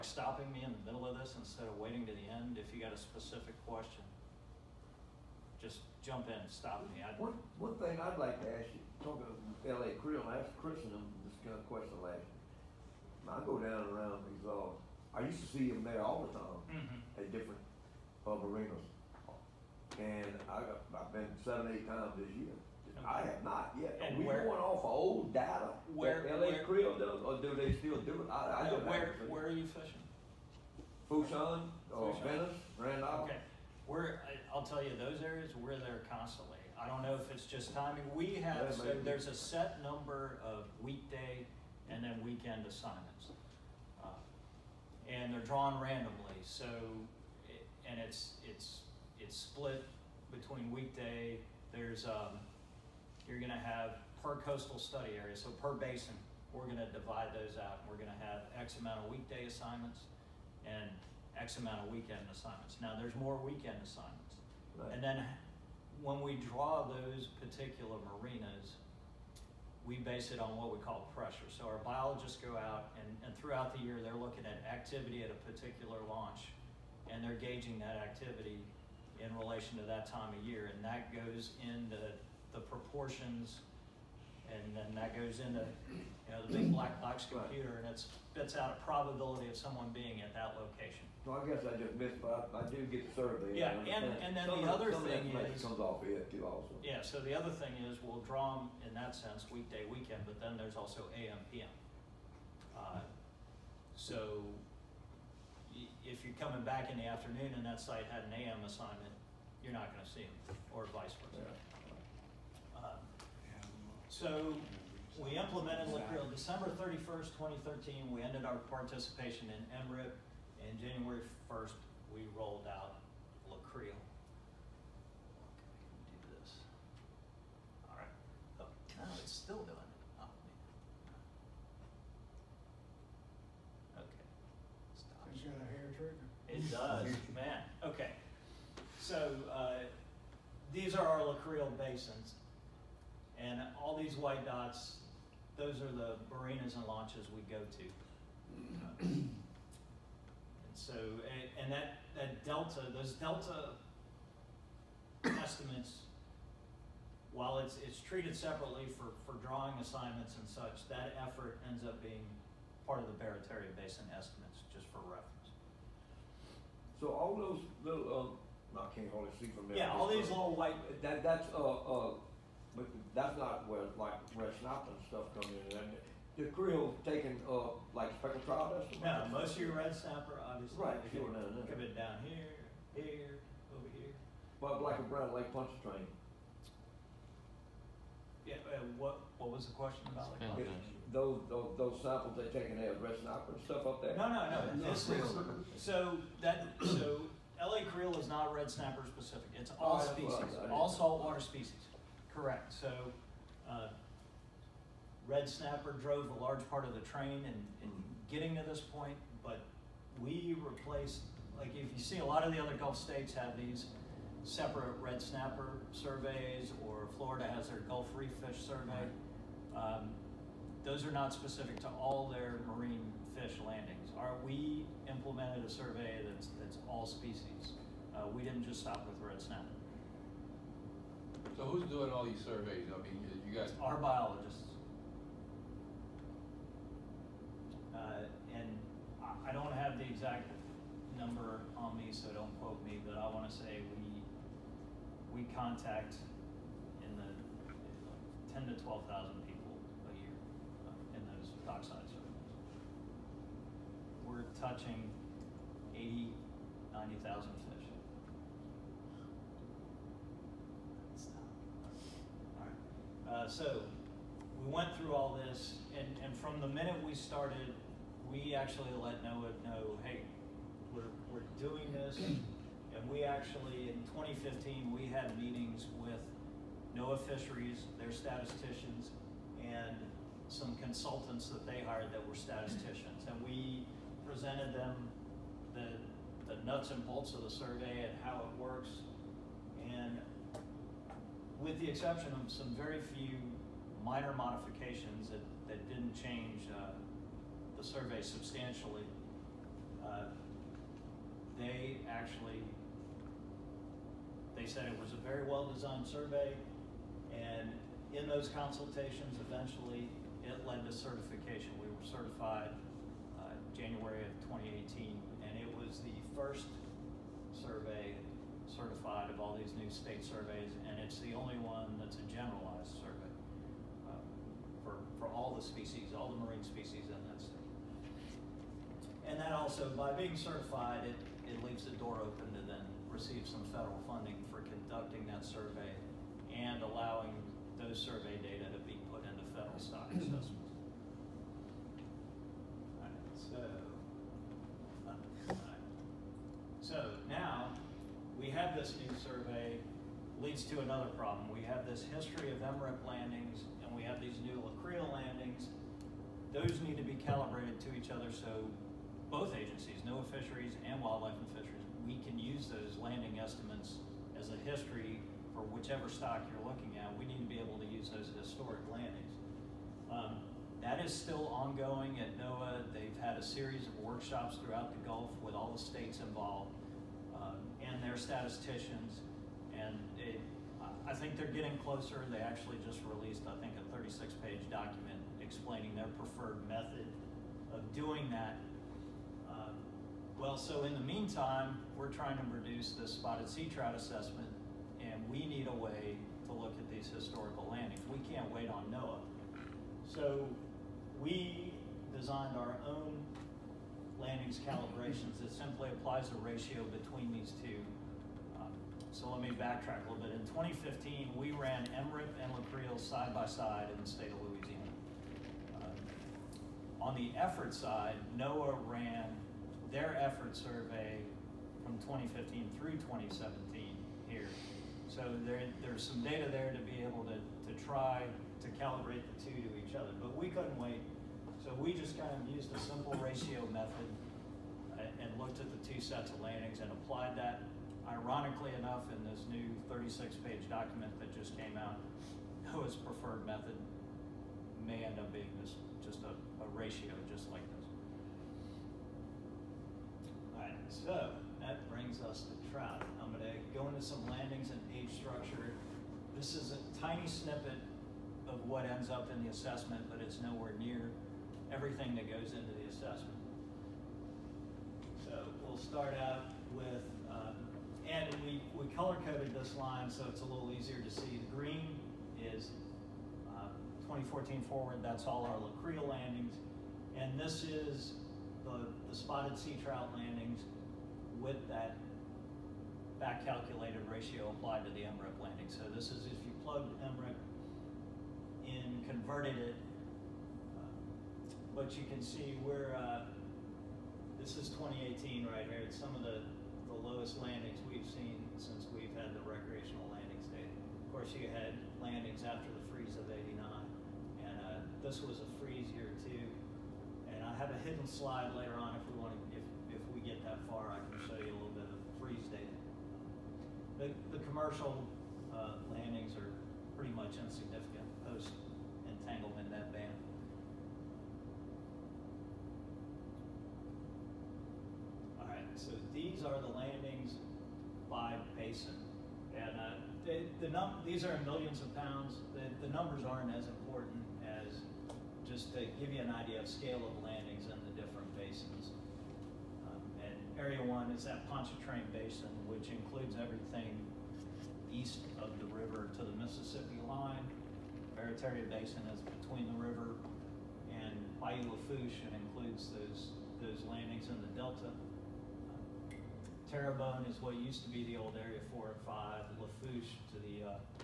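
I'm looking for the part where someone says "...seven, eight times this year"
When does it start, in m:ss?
0:21.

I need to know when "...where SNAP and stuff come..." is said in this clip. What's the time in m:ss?
2:54.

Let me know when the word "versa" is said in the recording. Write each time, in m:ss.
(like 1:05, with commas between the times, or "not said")
1:51.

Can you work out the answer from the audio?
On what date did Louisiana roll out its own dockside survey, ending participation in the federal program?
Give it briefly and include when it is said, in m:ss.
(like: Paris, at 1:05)
December 31st, 2013, at 1:56.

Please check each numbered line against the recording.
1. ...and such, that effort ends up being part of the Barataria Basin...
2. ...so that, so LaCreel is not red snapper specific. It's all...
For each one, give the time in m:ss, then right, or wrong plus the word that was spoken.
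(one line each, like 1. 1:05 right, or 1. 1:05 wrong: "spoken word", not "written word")
1. 2:40 right
2. 3:15 right.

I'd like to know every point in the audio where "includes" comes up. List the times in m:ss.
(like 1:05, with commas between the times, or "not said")
9:02, 9:12.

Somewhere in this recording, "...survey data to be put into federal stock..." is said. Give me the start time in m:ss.
5:37.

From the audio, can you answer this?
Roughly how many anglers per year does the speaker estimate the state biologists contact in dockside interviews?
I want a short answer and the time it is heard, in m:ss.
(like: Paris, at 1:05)
10 to 12,000, at 4:08.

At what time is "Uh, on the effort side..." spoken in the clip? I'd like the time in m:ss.
6:55.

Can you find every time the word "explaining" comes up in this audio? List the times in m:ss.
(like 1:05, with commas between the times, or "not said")
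6:25.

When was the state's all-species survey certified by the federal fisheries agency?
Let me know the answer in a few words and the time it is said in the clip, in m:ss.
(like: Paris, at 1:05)
January 2018, at 5:13.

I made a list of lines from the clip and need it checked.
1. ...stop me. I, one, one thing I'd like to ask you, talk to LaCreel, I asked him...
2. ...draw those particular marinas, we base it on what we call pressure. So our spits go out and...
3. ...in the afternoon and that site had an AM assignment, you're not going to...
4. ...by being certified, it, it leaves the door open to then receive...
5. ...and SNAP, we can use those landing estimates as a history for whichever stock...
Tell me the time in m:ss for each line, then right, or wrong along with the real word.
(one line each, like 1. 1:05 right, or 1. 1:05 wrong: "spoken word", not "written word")
1. 0:06 right
2. 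1:06 wrong: "biologists", not "spits"
3. 1:46 right
4. 5:29 right
5. 6:01 wrong: "Fisheries", not "SNAP".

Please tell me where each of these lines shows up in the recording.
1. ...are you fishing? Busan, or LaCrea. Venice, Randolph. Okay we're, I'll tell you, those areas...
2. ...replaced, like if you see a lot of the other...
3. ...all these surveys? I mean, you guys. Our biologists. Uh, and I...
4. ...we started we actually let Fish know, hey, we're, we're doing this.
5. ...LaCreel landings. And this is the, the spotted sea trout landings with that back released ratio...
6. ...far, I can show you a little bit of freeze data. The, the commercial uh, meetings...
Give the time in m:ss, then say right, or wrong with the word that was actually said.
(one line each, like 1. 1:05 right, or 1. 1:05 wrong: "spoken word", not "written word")
1. 0:29 wrong: "Busan", not "LaCrea"
2. 3:30 right
3. 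3:52 right
4. 4:27 wrong: "NOAA", not "Fish"
5. 7:55 wrong: "calculated", not "released"
6. 8:30 wrong: "landings", not "meetings".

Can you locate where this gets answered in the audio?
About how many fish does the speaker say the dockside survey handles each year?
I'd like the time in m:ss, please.
4:15.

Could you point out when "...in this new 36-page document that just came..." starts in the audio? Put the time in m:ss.
7:19.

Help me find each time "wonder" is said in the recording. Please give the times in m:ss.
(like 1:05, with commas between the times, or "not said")
not said.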